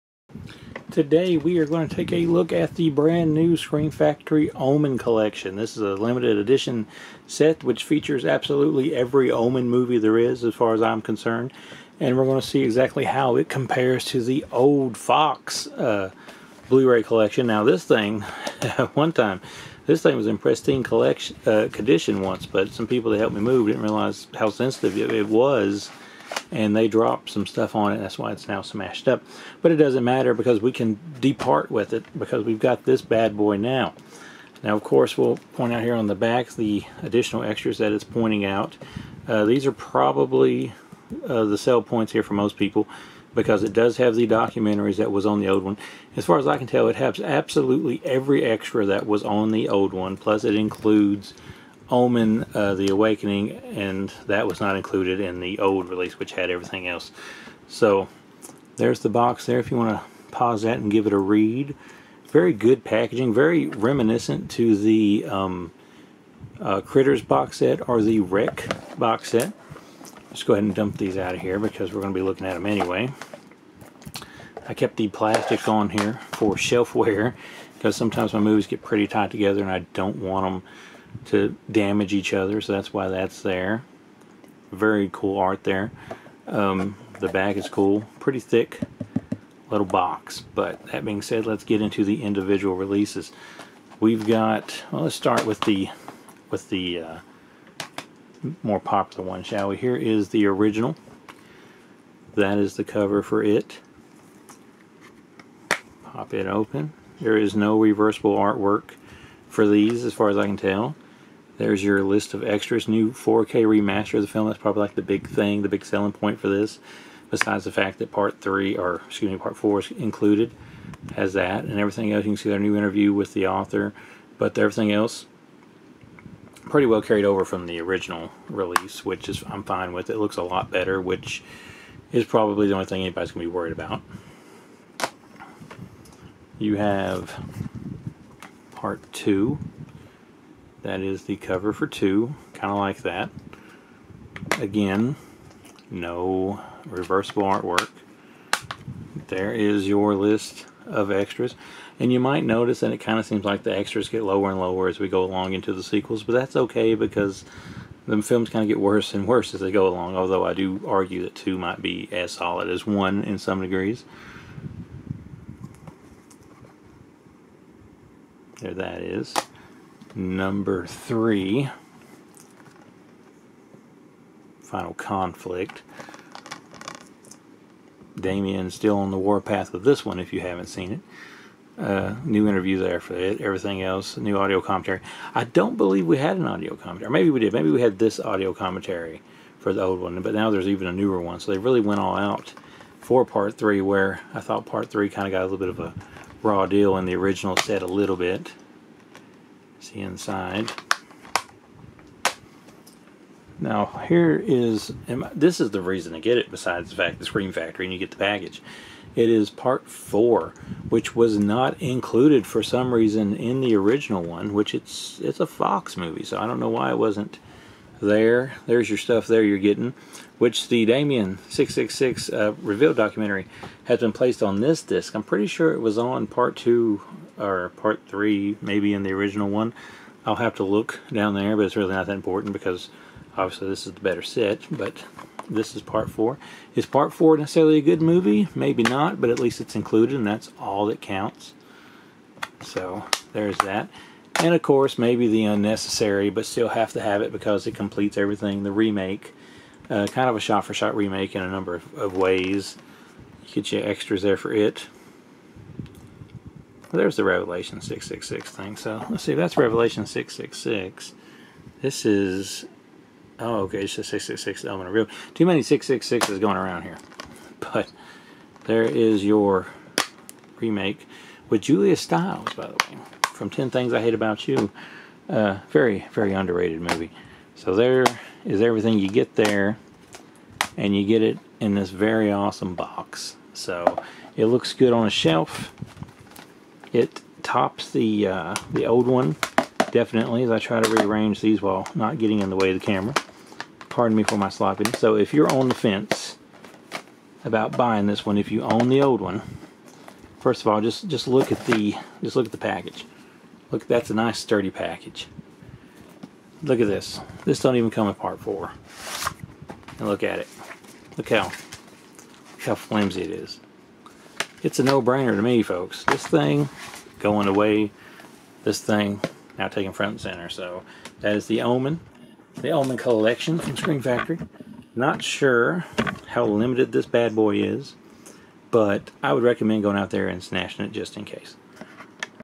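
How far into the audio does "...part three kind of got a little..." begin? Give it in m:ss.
3:14.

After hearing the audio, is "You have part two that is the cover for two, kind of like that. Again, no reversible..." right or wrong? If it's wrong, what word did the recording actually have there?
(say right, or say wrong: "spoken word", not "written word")
right.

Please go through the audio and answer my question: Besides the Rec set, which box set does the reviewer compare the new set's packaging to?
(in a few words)
Critters.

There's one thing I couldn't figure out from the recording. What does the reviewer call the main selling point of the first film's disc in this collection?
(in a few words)
New 4K remaster.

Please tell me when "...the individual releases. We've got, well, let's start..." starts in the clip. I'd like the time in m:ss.
1:32.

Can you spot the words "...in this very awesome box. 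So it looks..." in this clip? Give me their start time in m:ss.
4:41.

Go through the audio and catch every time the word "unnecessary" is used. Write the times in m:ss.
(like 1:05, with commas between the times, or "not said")
4:05.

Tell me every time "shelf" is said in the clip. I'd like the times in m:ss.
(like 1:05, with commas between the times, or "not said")
1:16, 4:45.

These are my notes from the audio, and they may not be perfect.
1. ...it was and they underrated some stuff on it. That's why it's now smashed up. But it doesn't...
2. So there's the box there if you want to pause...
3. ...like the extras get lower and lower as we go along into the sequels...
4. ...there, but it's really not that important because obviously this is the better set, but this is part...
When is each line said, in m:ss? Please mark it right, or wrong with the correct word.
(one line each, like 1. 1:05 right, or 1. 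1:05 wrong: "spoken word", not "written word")
1. 0:24 wrong: "dropped", not "underrated"
2. 0:57 right
3. 2:33 right
4. 3:51 right.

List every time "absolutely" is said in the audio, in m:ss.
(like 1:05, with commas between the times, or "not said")
0:08, 0:47.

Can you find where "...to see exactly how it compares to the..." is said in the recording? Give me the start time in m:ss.
0:12.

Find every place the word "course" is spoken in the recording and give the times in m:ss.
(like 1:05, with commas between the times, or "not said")
0:34, 4:04.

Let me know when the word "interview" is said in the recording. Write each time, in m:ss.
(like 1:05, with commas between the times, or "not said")
2:02, 3:02.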